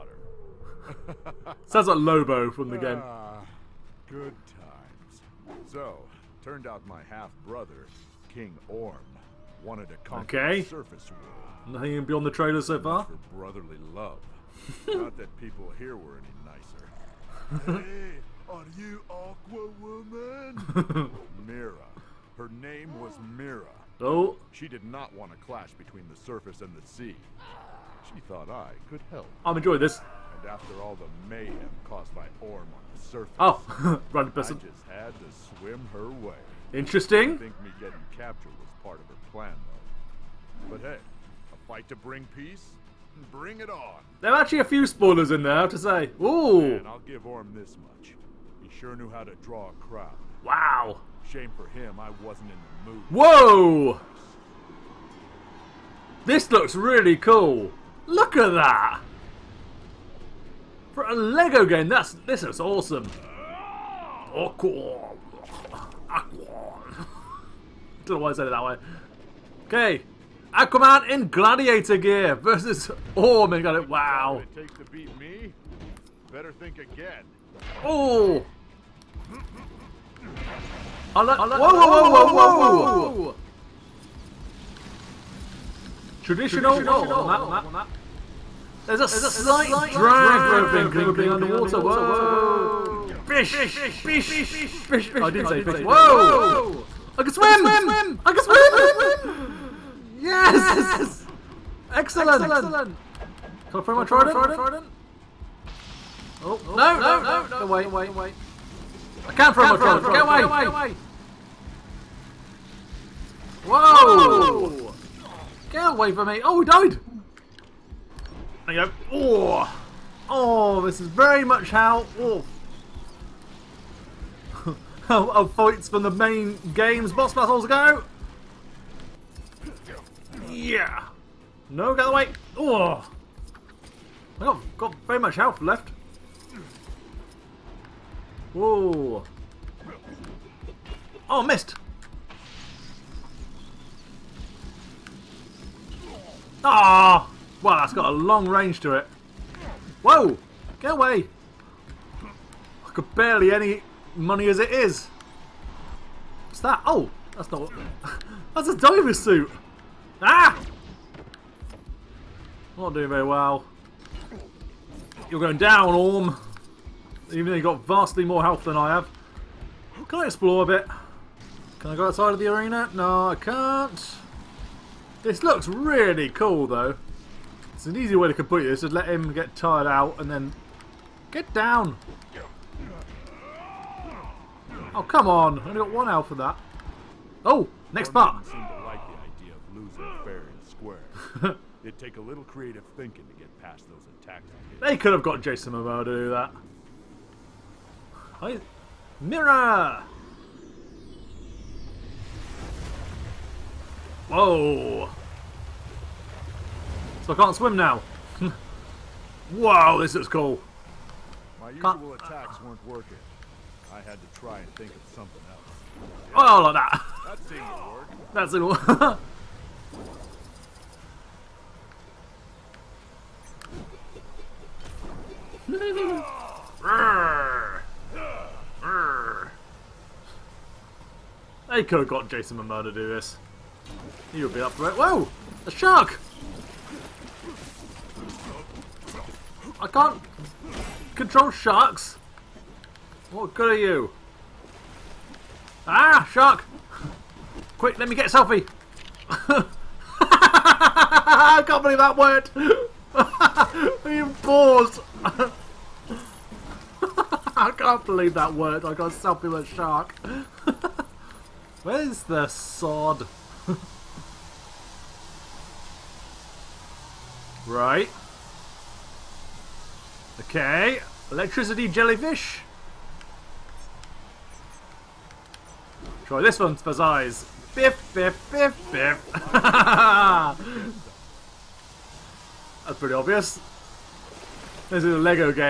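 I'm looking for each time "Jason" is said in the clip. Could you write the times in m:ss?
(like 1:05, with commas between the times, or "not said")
3:15, 3:52.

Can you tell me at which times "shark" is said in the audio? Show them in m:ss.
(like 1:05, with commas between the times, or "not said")
3:55, 4:01, 4:06, 4:19.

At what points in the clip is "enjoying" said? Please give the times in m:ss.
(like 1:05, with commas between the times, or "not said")
0:29.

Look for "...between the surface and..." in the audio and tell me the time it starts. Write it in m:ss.
0:25.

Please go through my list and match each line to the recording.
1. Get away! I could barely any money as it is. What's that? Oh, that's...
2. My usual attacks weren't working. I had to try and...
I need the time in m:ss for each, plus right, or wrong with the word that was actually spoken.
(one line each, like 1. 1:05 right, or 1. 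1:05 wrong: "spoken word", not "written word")
1. 2:30 right
2. 3:31 right.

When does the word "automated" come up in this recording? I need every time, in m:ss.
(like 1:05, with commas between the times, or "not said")
not said.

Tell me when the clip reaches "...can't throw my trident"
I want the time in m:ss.
1:49.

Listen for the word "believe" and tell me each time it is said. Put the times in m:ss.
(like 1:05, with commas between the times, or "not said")
4:11, 4:18.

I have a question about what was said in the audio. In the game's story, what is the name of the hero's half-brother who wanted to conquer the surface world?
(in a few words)
King Orm.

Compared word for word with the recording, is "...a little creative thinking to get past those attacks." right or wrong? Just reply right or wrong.
right.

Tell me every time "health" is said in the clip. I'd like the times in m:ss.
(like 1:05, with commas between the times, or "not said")
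2:15, 2:48, 3:06.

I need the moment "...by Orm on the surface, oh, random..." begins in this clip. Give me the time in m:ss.
0:32.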